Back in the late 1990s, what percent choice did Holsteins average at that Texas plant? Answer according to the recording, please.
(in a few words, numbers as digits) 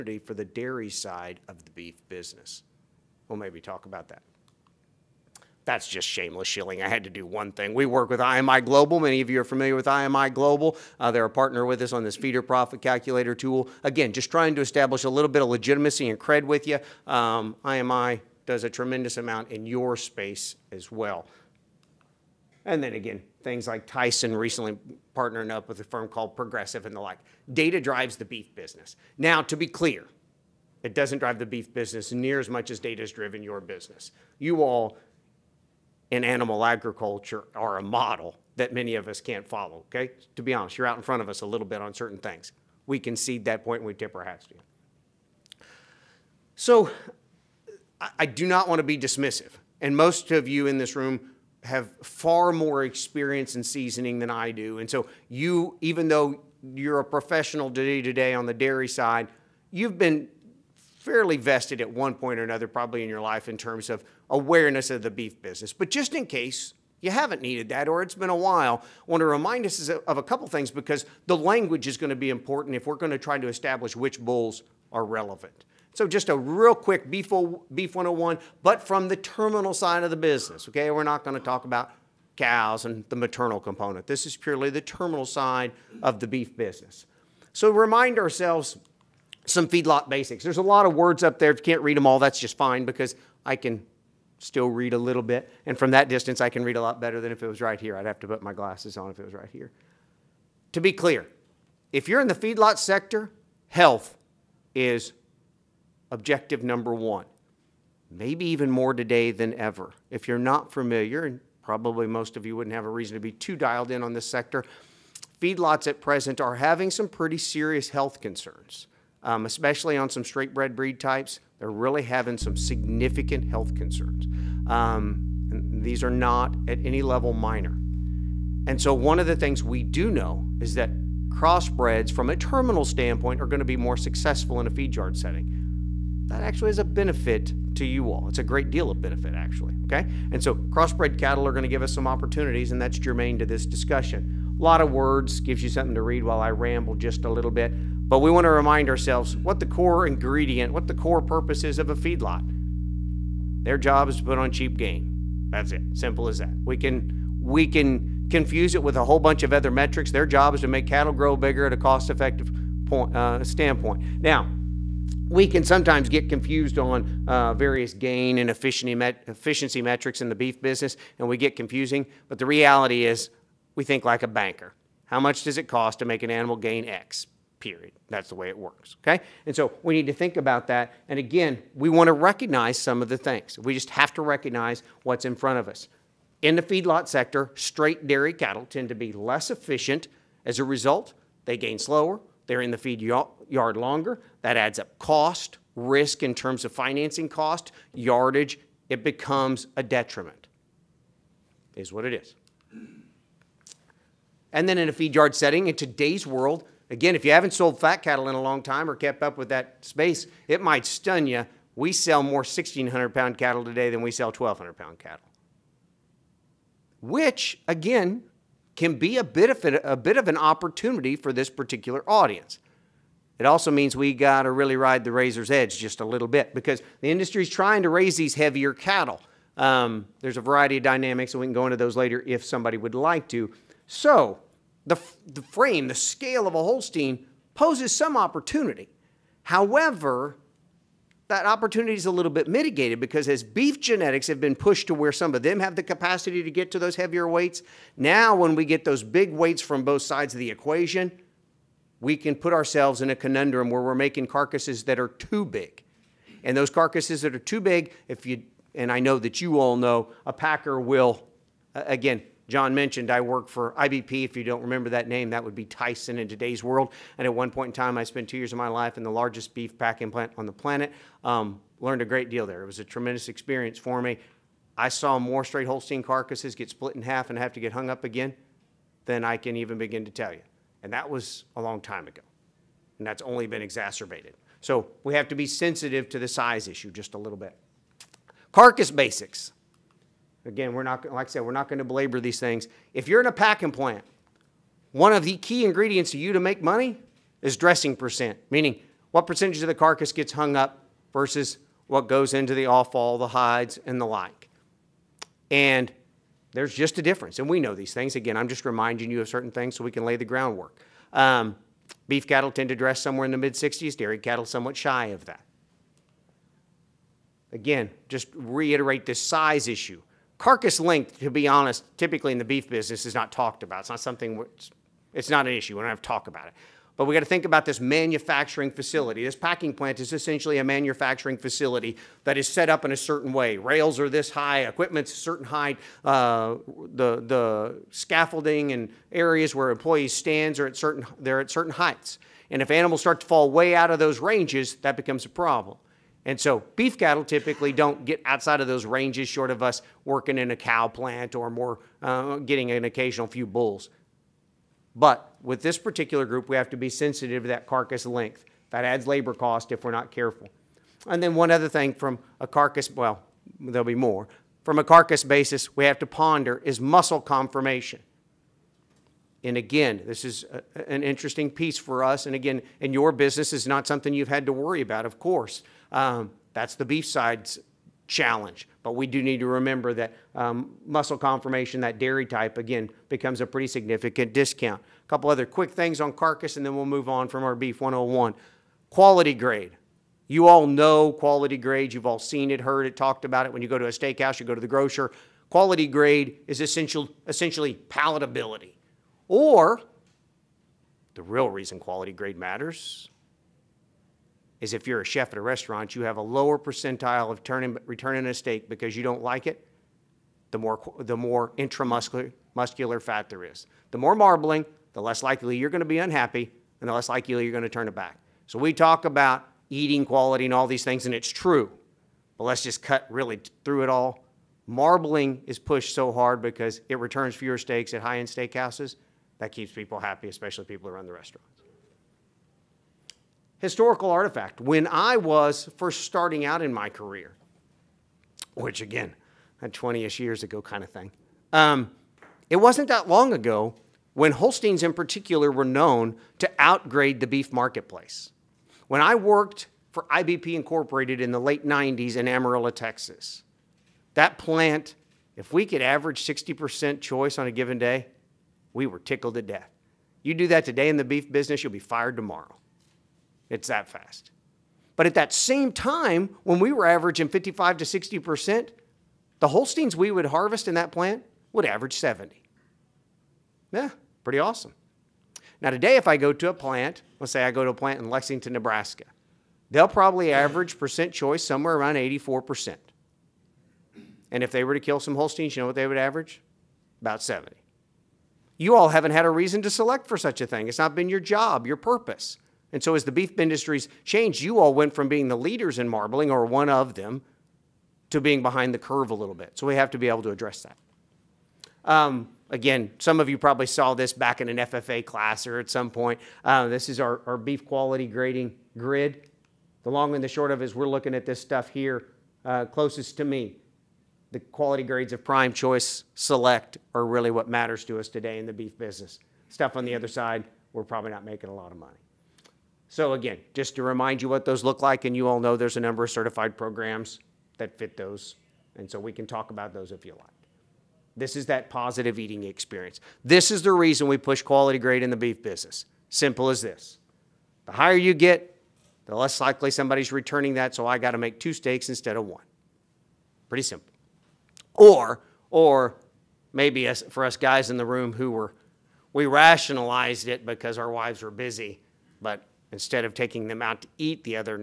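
70%.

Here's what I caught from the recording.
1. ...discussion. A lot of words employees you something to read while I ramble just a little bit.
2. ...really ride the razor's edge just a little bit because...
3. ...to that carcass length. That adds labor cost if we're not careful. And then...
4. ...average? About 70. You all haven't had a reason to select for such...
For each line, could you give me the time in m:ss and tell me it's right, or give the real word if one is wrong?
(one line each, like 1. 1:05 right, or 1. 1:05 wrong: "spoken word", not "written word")
1. 2:23 wrong: "gives", not "employees"
2. 3:44 right
3. 5:57 right
4. 8:05 right.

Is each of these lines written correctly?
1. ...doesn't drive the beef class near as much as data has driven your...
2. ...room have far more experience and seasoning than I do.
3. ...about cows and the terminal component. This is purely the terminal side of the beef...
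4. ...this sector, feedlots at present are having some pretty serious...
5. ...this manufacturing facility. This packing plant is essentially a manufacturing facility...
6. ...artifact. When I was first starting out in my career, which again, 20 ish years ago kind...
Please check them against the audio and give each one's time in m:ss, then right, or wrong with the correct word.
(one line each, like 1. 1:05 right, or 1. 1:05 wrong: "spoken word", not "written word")
1. 0:30 wrong: "business", not "class"
2. 0:50 right
3. 1:21 wrong: "maternal", not "terminal"
4. 1:54 right
5. 5:27 right
6. 7:14 right.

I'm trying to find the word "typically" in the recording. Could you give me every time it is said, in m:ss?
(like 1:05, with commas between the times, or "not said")
5:21, 5:47.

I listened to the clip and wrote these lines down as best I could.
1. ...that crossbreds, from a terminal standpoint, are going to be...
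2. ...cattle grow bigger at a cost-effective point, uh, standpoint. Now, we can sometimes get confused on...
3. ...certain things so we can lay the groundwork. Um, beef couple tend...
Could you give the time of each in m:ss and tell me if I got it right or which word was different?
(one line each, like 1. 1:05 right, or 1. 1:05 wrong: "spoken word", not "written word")
1. 2:10 right
2. 2:40 right
3. 5:09 wrong: "cattle", not "couple".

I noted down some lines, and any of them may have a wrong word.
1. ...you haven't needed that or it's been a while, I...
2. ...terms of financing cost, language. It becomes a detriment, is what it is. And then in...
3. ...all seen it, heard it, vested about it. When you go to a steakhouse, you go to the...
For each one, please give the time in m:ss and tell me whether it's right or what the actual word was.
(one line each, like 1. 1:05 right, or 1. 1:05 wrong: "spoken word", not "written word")
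1. 1:07 right
2. 3:16 wrong: "yardage", not "language"
3. 6:32 wrong: "talked", not "vested".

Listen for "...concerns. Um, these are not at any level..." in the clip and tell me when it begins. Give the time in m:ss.
2:03.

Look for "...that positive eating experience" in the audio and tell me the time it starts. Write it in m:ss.
8:51.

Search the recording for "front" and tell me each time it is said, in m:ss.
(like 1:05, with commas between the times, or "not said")
0:41, 3:05.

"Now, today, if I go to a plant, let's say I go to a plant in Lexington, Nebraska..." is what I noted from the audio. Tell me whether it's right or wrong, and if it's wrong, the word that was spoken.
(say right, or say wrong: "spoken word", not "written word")
right.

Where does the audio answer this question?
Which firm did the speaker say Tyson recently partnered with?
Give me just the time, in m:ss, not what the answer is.
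0:26.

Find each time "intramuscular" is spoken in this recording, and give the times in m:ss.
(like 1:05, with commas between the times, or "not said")
6:51.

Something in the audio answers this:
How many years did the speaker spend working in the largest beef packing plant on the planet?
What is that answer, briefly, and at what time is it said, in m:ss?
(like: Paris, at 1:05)
2, at 4:28.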